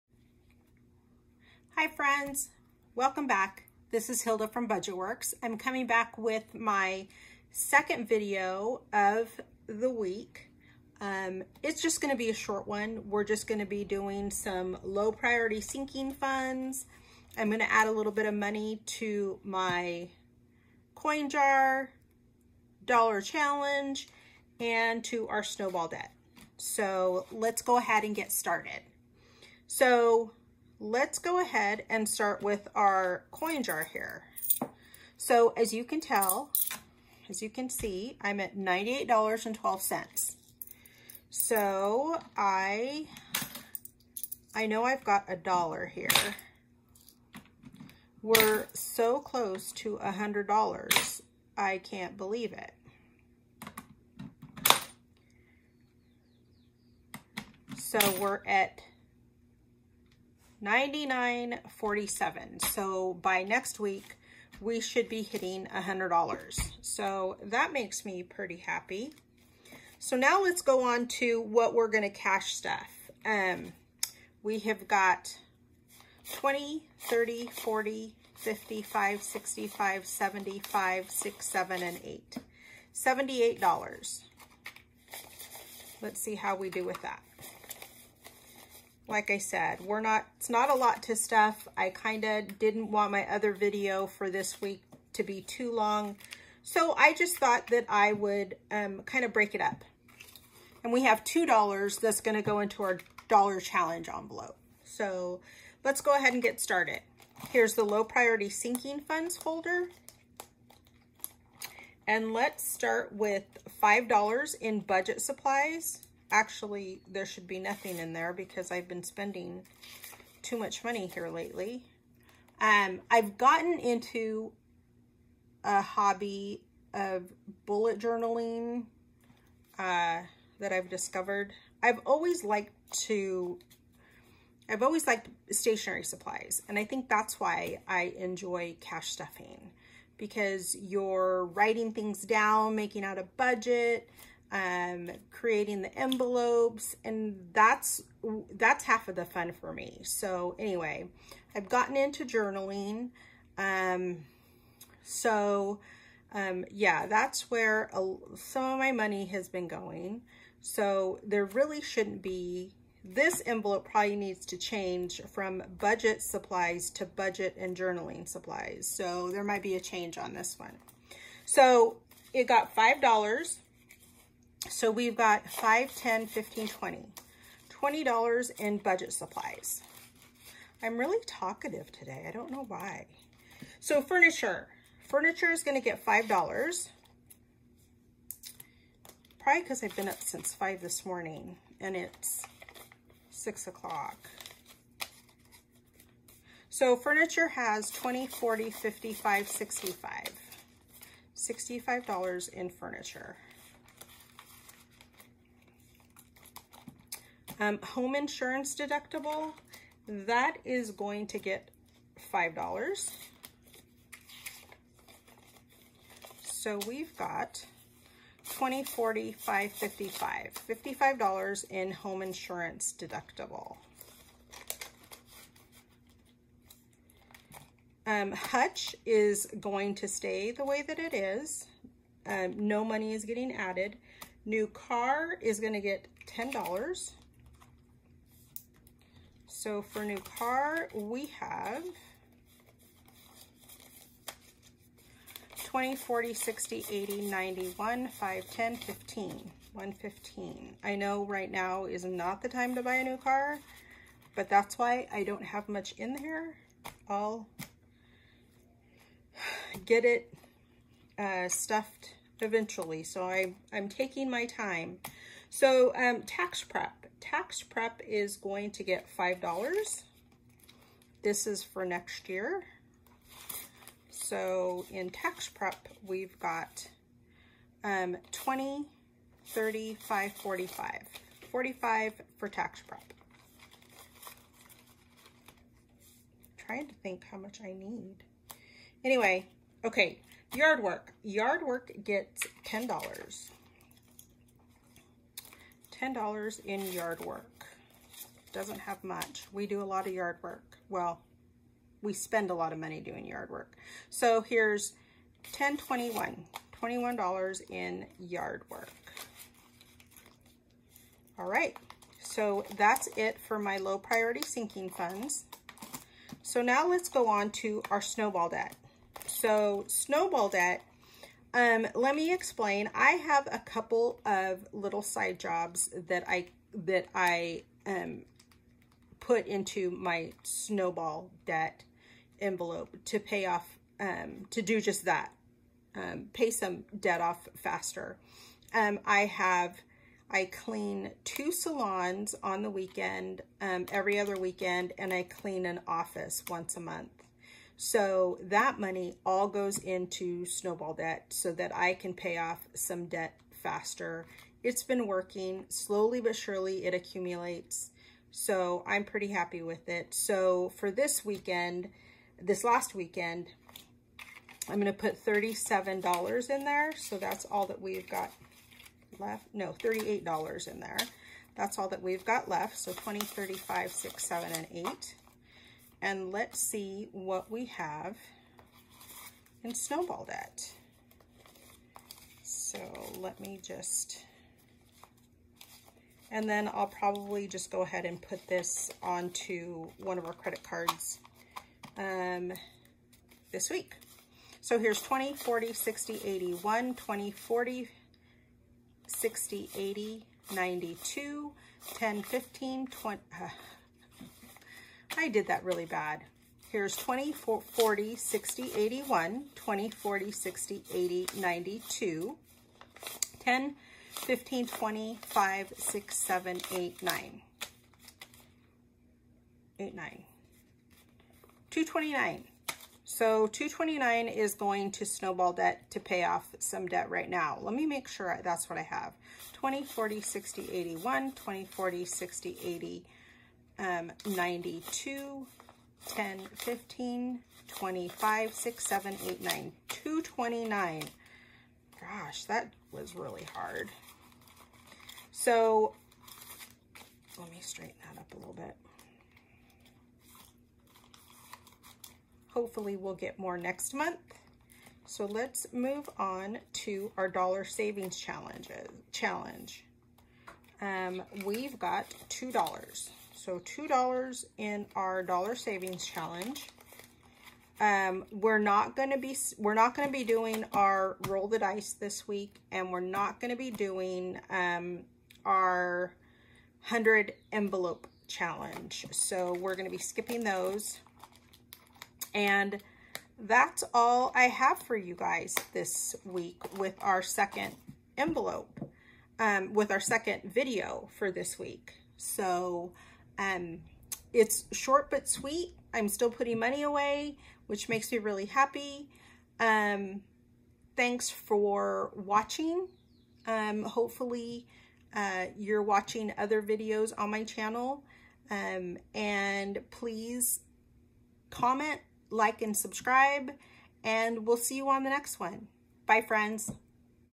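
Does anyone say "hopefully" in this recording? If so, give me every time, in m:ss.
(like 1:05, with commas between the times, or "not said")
7:32, 8:23.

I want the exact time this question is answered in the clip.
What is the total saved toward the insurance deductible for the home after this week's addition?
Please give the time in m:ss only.
3:40.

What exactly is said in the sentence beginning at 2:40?
So there really shouldn't be, this envelope probably needs to change from budget supplies to budget and journaling supplies.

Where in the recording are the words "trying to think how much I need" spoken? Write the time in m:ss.
4:46.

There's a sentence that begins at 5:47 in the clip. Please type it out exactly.
So that money all goes into snowball debt so that I can pay off some debt faster.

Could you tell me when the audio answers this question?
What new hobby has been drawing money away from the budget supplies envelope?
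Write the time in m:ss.
2:07.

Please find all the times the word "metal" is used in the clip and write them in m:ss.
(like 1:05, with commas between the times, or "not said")
not said.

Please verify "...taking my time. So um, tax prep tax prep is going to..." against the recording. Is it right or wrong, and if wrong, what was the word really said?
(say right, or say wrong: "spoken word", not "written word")
right.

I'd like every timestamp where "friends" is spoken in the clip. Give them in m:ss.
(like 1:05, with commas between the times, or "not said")
0:01, 8:36.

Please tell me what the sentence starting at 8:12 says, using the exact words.
So um, it's short but sweet.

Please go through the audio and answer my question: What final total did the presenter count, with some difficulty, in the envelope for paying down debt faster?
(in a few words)
$229.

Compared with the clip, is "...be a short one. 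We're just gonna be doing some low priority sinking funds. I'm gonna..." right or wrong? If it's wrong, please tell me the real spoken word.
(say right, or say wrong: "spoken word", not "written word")
right.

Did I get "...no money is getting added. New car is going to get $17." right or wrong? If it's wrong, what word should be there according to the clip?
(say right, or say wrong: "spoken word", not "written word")
wrong: "10", not "17".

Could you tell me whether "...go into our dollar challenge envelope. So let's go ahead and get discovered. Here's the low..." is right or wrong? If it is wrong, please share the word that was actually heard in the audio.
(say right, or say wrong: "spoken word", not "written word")
wrong: "started", not "discovered".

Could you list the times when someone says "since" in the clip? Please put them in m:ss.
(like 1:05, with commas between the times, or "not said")
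3:10.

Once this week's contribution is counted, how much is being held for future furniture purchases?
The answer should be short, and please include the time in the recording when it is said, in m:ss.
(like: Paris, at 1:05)
$65, at 3:21.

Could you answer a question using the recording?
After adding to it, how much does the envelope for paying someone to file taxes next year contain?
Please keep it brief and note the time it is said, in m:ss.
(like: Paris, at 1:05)
$45, at 4:41.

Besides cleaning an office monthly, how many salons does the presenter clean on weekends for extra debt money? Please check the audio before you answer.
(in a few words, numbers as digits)
2.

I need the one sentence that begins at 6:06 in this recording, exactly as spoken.
So that's all that we've got left.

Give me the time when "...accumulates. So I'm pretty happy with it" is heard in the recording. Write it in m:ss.
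5:56.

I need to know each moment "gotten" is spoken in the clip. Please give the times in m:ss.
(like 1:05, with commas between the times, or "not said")
2:03, 2:31.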